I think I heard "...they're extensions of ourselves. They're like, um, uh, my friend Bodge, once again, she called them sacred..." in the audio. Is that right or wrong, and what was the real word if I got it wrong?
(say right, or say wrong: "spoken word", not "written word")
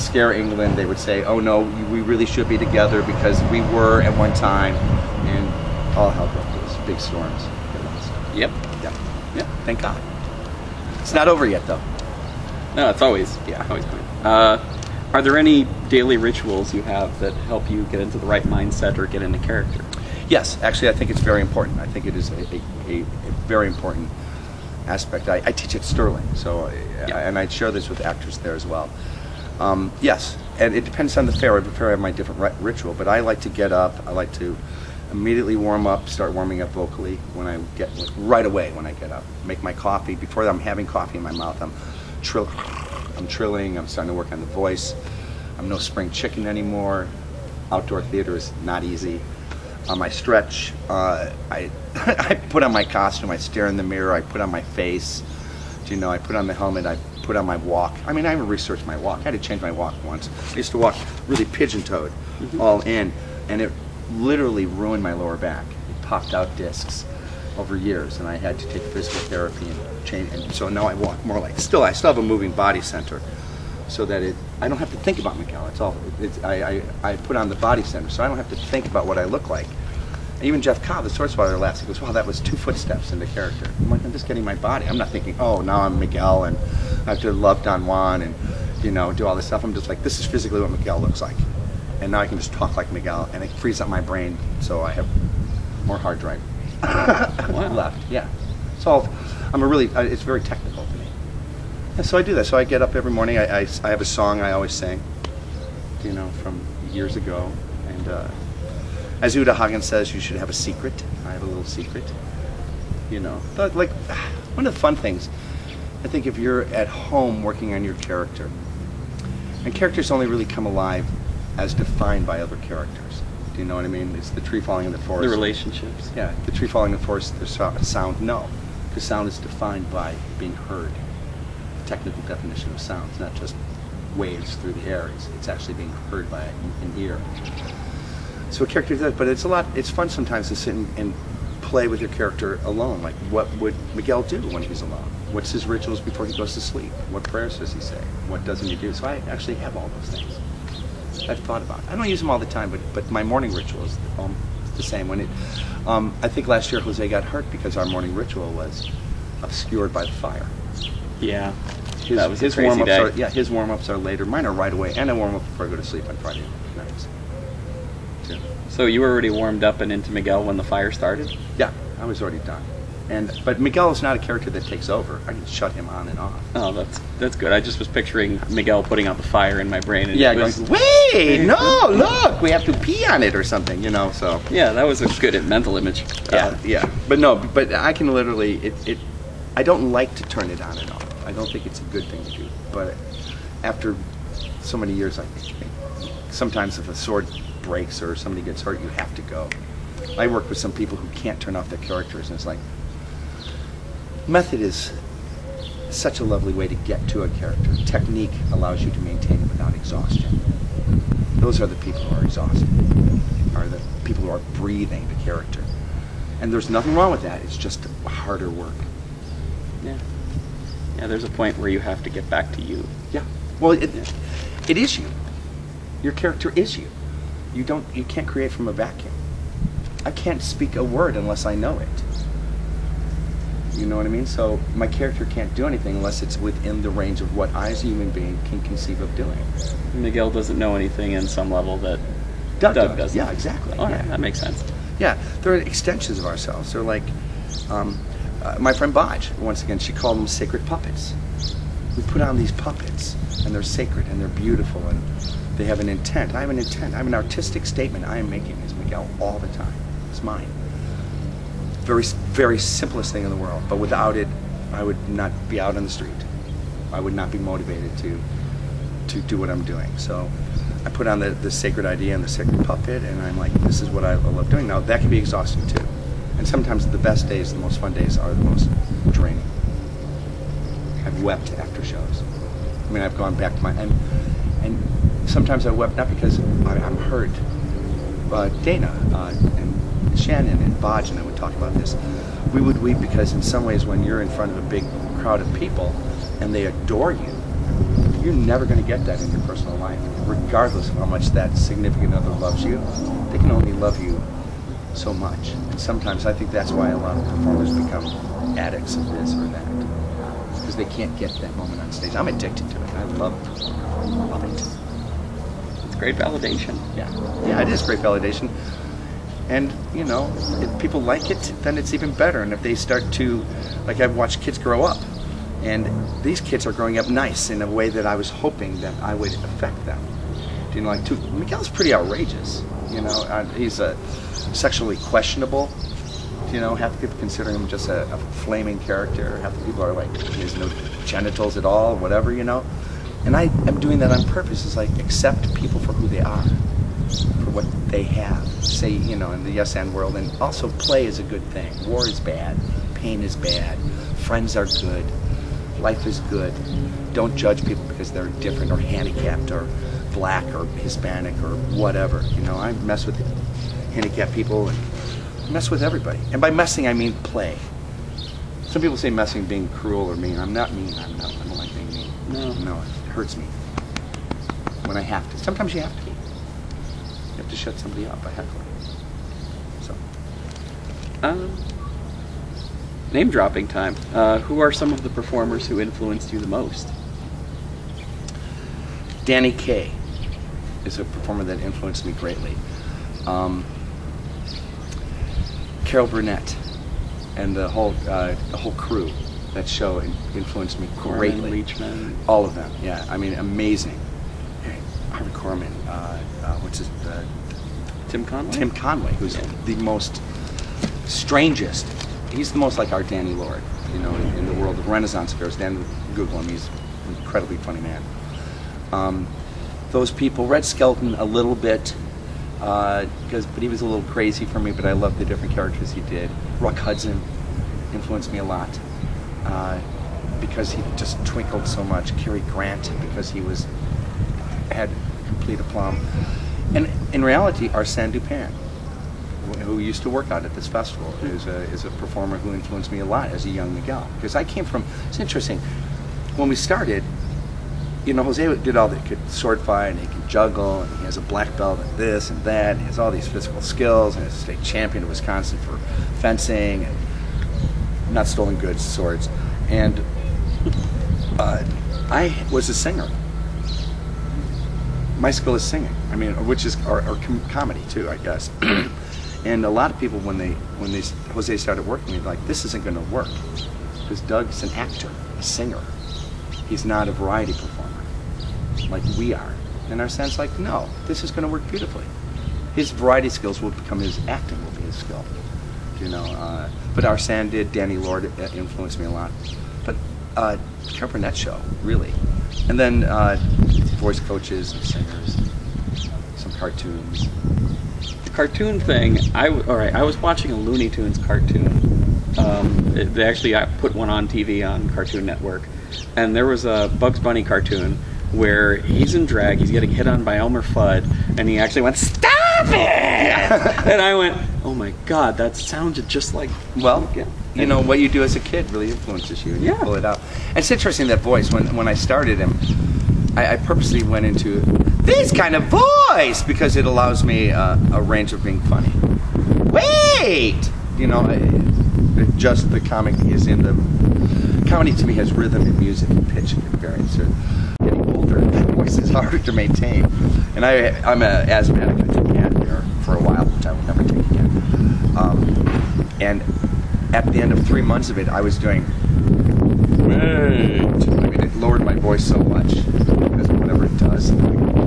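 right.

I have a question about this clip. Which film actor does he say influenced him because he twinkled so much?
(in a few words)
Rock Hudson.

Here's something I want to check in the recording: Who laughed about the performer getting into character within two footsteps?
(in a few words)
Jeff Cobb.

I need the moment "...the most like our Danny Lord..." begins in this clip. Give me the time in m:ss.
6:52.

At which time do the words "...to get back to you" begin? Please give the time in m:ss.
3:42.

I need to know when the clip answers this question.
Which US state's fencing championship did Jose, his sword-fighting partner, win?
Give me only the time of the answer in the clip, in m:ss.
7:35.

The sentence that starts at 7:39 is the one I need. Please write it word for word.
And uh, I was a singer my skill is singing.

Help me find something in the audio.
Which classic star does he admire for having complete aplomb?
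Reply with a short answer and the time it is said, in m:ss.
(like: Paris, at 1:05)
Cary Grant, at 7:12.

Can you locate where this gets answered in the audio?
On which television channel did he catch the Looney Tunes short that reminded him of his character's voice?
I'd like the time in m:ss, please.
8:24.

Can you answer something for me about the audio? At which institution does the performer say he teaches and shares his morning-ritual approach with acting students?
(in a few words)
Sterling.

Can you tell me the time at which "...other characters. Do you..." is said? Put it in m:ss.
2:02.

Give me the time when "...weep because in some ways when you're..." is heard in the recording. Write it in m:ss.
4:52.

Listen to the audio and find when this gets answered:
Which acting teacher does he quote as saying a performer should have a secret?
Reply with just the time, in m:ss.
1:49.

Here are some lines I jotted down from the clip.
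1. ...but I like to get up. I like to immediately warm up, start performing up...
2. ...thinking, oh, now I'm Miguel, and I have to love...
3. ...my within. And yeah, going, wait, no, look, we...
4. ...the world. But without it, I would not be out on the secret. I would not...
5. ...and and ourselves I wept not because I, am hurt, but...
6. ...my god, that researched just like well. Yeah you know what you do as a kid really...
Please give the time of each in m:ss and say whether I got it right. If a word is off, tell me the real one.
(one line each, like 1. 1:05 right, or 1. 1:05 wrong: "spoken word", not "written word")
1. 0:32 wrong: "warming", not "performing"
2. 1:25 right
3. 2:59 wrong: "brain", not "within"
4. 4:23 wrong: "street", not "secret"
5. 4:43 wrong: "sometimes", not "ourselves"
6. 8:34 wrong: "sounded", not "researched".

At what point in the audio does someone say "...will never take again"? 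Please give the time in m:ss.
9:03.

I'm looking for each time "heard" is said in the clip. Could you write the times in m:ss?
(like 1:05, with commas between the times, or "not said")
2:10, 2:16.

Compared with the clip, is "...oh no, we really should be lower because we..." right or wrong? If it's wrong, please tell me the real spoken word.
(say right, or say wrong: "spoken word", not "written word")
wrong: "together", not "lower".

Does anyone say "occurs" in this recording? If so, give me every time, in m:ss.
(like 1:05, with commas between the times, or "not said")
not said.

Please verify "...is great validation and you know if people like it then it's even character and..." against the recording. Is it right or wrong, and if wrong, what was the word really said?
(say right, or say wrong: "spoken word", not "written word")
wrong: "better", not "character".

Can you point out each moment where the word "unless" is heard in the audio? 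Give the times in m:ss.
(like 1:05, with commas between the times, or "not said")
3:51, 3:55.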